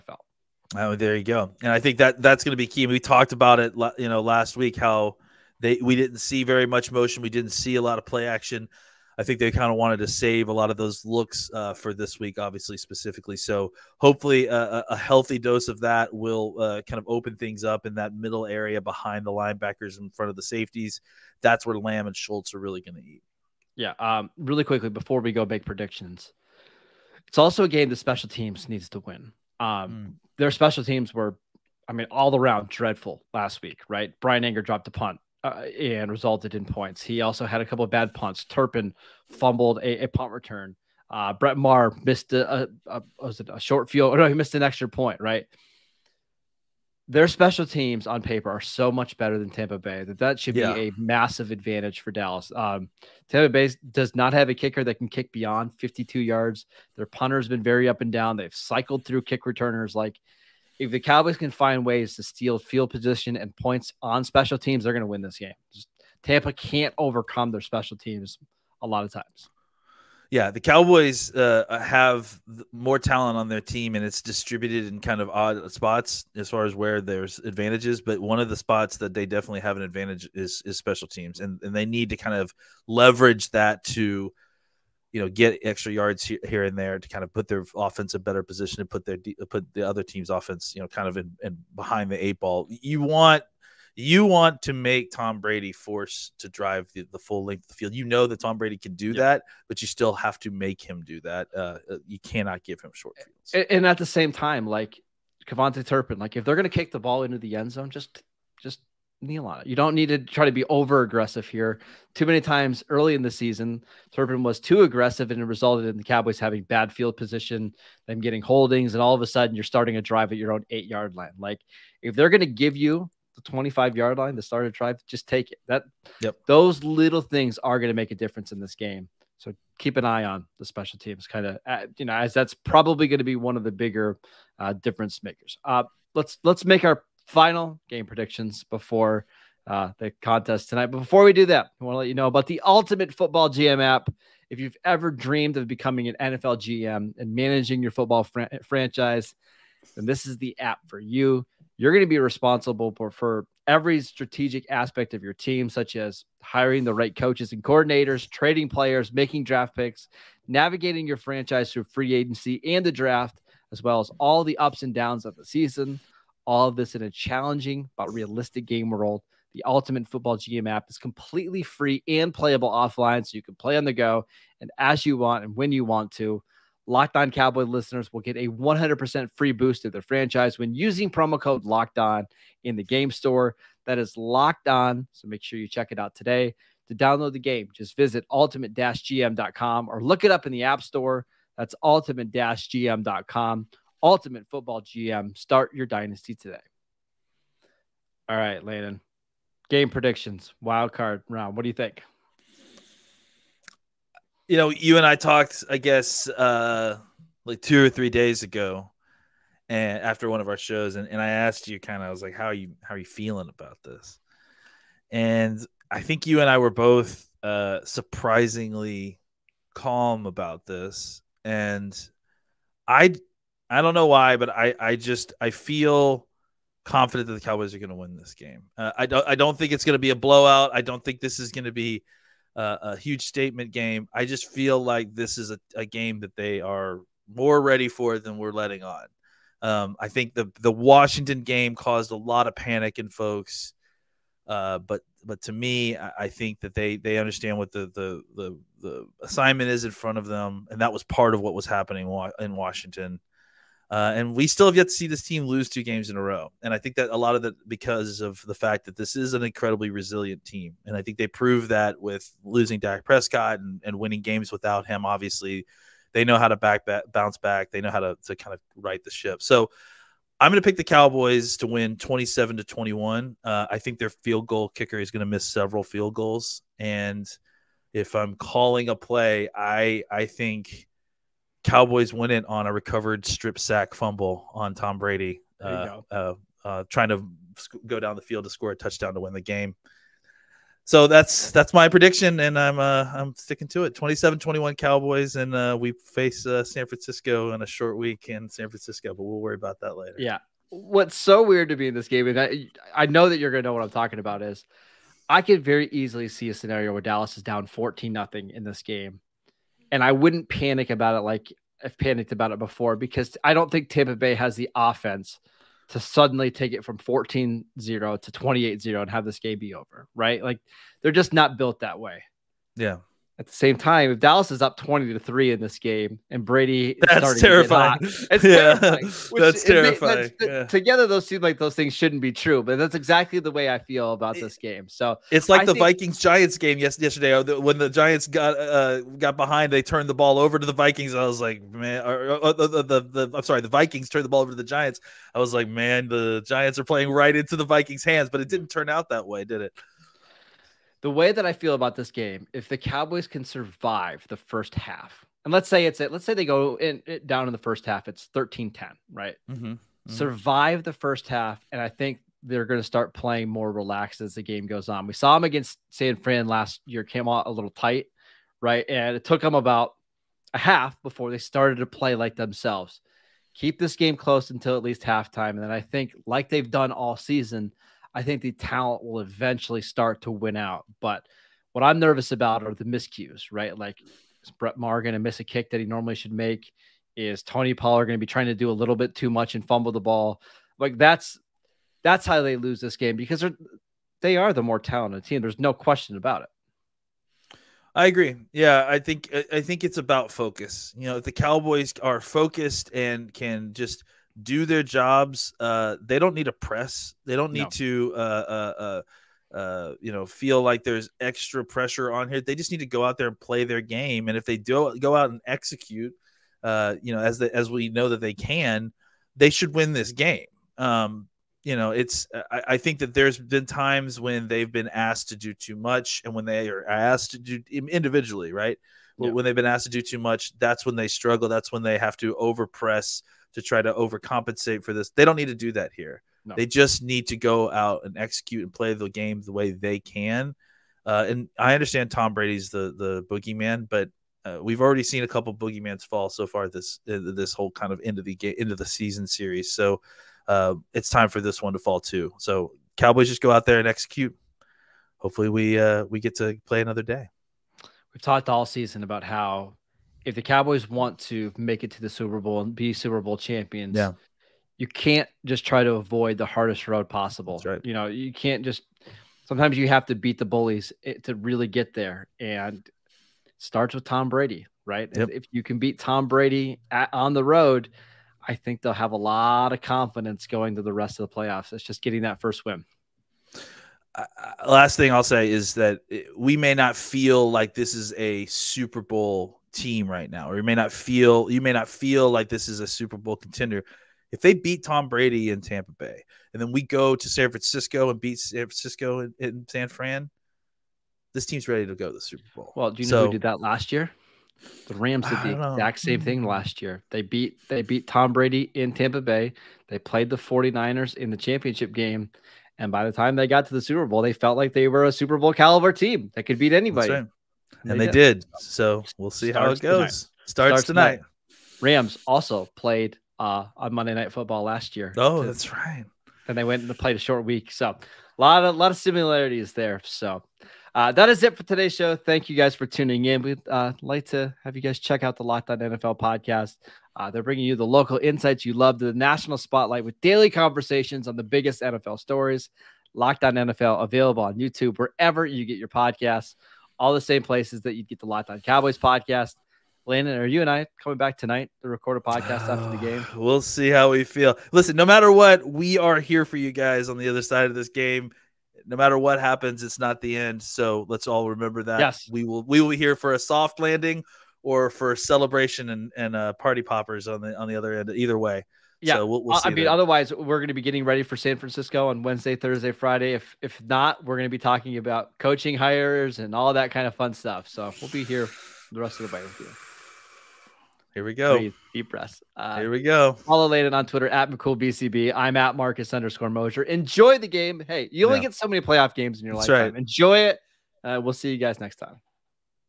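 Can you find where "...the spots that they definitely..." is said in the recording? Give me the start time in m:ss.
1:18.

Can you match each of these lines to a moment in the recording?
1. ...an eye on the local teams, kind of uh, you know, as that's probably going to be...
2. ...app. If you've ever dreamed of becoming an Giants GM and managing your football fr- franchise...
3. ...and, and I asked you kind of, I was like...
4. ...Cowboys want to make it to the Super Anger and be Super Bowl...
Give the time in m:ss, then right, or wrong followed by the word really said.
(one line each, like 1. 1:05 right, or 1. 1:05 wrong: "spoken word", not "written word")
1. 2:09 wrong: "special", not "local"
2. 2:23 wrong: "NFL", not "Giants"
3. 3:30 right
4. 7:40 wrong: "Bowl", not "Anger".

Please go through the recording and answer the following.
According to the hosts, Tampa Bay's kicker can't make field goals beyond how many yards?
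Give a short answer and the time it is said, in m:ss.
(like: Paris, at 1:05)
52, at 0:55.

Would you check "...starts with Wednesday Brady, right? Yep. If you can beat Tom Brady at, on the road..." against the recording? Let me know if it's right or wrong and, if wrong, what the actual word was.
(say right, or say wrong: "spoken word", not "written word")
wrong: "Tom", not "Wednesday".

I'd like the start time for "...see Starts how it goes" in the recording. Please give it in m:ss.
8:39.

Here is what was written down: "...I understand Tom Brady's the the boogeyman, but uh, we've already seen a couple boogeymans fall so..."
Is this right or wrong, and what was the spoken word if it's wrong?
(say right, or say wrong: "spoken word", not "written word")
right.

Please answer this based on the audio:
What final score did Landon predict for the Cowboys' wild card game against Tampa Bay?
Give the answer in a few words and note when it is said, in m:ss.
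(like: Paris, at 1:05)
27-21, at 4:53.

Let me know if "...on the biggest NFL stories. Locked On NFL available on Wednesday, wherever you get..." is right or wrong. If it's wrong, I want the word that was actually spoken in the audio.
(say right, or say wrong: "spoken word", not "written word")
wrong: "YouTube", not "Wednesday".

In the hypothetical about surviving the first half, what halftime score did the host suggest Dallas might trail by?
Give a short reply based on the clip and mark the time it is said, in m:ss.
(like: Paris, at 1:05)
13-10, at 5:58.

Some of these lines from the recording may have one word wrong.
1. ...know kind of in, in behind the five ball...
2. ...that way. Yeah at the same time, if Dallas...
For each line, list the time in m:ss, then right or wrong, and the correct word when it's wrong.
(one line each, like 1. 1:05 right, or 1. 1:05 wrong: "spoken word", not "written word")
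1. 1:30 wrong: "eight", not "five"
2. 5:21 right.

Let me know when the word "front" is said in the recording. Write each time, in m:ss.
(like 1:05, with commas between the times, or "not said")
0:20, 4:09.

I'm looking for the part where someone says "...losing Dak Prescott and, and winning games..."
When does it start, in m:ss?
4:22.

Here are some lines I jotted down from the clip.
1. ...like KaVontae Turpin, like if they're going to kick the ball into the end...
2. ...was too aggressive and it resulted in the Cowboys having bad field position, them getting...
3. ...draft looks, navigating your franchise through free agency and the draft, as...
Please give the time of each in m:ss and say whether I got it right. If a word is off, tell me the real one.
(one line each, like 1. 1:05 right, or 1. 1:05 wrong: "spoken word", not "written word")
1. 1:44 right
2. 1:54 right
3. 2:39 wrong: "picks", not "looks".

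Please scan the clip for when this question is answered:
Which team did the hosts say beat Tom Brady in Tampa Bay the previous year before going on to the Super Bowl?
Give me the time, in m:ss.
8:24.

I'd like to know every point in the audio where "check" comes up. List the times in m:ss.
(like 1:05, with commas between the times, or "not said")
3:05, 8:54.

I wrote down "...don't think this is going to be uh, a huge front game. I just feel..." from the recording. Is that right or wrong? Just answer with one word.
wrong.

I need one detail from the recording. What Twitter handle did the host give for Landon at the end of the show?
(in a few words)
McCoolBCB.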